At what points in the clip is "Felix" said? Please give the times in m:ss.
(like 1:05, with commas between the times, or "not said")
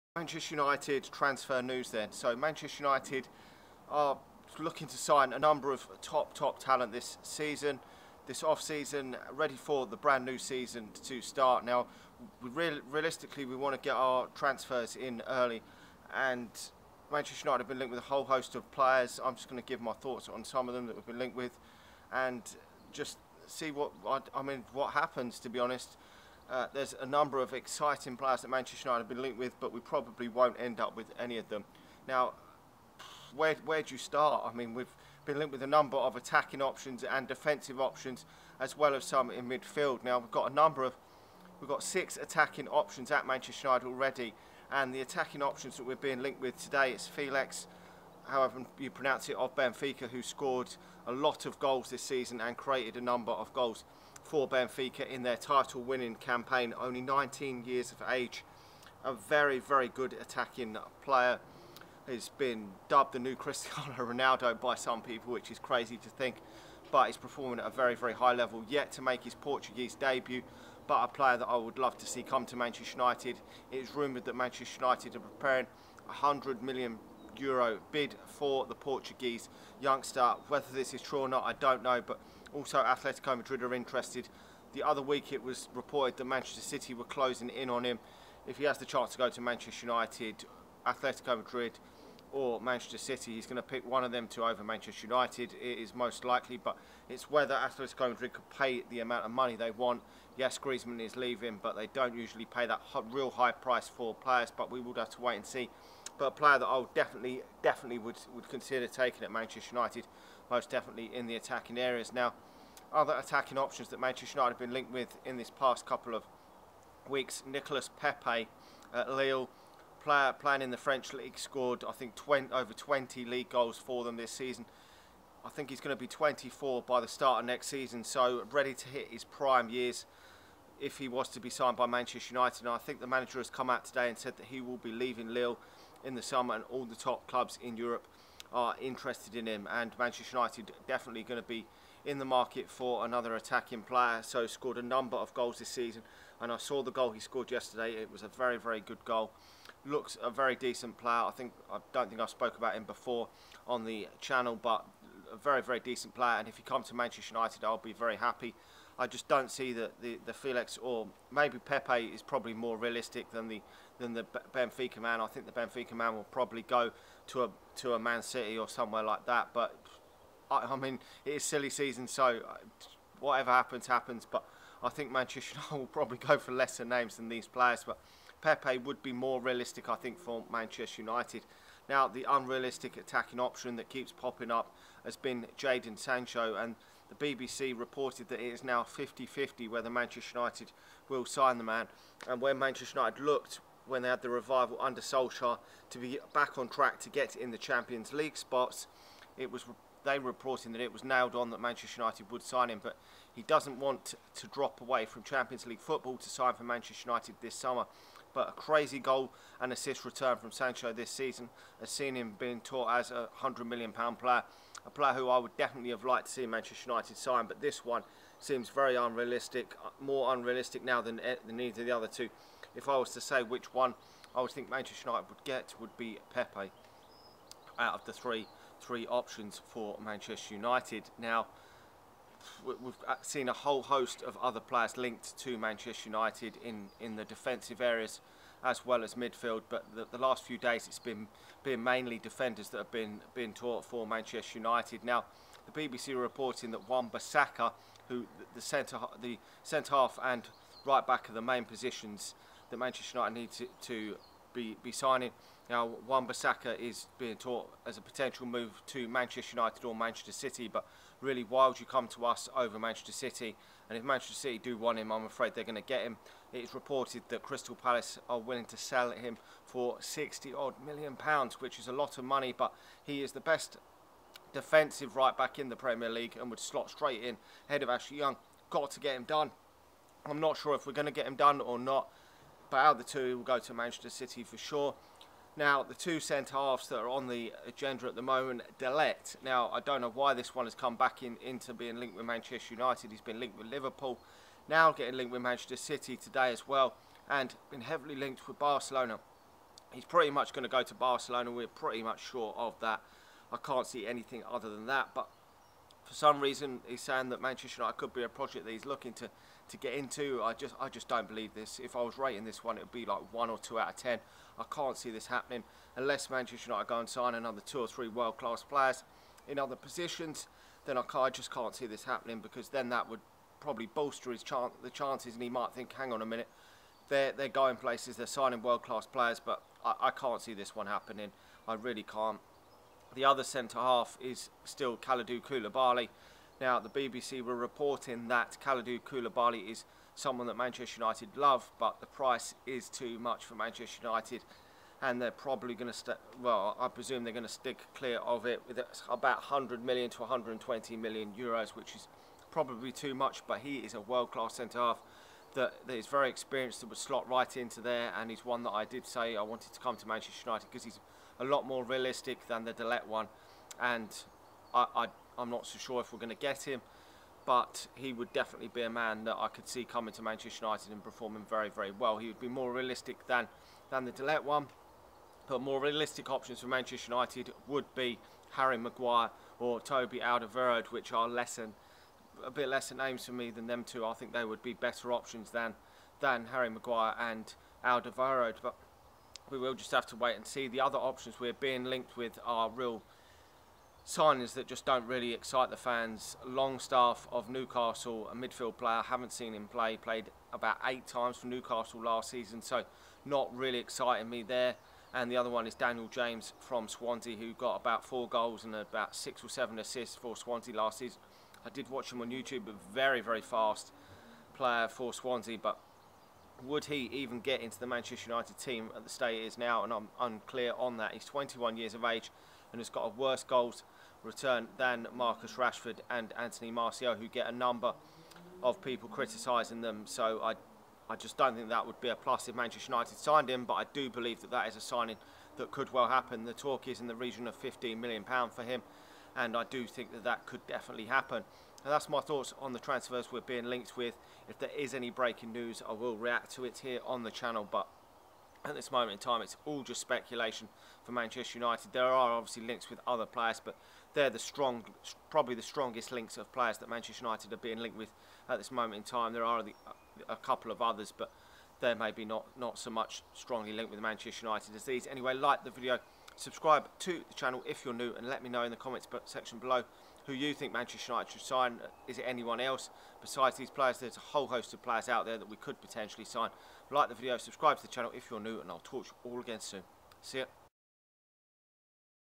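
0:47, 2:40.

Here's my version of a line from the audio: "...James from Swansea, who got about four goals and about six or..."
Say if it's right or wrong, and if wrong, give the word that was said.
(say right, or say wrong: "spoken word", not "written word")
right.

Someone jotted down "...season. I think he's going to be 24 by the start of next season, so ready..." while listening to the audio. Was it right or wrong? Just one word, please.
right.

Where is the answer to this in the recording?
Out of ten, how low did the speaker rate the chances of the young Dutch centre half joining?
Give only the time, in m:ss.
5:13.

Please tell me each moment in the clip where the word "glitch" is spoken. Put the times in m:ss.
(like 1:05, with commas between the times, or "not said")
not said.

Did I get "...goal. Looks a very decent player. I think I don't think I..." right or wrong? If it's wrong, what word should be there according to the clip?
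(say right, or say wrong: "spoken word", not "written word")
right.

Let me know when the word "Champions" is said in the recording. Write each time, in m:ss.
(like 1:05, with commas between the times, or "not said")
3:17, 3:25.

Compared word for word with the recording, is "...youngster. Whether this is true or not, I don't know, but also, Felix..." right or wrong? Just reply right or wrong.
wrong.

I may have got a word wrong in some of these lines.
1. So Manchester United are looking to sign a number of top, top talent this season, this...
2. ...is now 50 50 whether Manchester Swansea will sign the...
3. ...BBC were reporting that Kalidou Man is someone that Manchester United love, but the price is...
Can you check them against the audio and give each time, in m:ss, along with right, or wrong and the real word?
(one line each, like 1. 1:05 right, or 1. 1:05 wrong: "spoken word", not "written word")
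1. 0:02 right
2. 3:08 wrong: "United", not "Swansea"
3. 5:36 wrong: "Koulibaly", not "Man".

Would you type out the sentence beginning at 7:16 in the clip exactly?
The talk is in the region of £15 million for him, and I do think that that could definitely happen.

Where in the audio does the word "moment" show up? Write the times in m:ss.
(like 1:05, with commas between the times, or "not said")
4:48, 7:28, 7:38.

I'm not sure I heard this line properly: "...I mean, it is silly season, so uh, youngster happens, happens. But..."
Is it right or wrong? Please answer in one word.
wrong.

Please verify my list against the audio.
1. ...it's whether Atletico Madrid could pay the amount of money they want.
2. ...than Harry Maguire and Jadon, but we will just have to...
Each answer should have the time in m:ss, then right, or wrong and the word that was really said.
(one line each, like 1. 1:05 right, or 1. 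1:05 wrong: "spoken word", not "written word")
1. 1:37 right
2. 6:26 wrong: "Alderweireld", not "Jadon".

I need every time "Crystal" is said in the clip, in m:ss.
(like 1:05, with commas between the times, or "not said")
4:27.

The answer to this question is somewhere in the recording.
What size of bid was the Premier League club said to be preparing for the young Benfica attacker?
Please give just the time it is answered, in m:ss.
1:16.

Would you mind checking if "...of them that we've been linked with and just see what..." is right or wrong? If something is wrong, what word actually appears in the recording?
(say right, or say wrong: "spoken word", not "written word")
right.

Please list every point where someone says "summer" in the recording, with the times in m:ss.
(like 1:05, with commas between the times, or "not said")
2:16, 3:27.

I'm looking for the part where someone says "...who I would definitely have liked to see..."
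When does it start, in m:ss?
3:35.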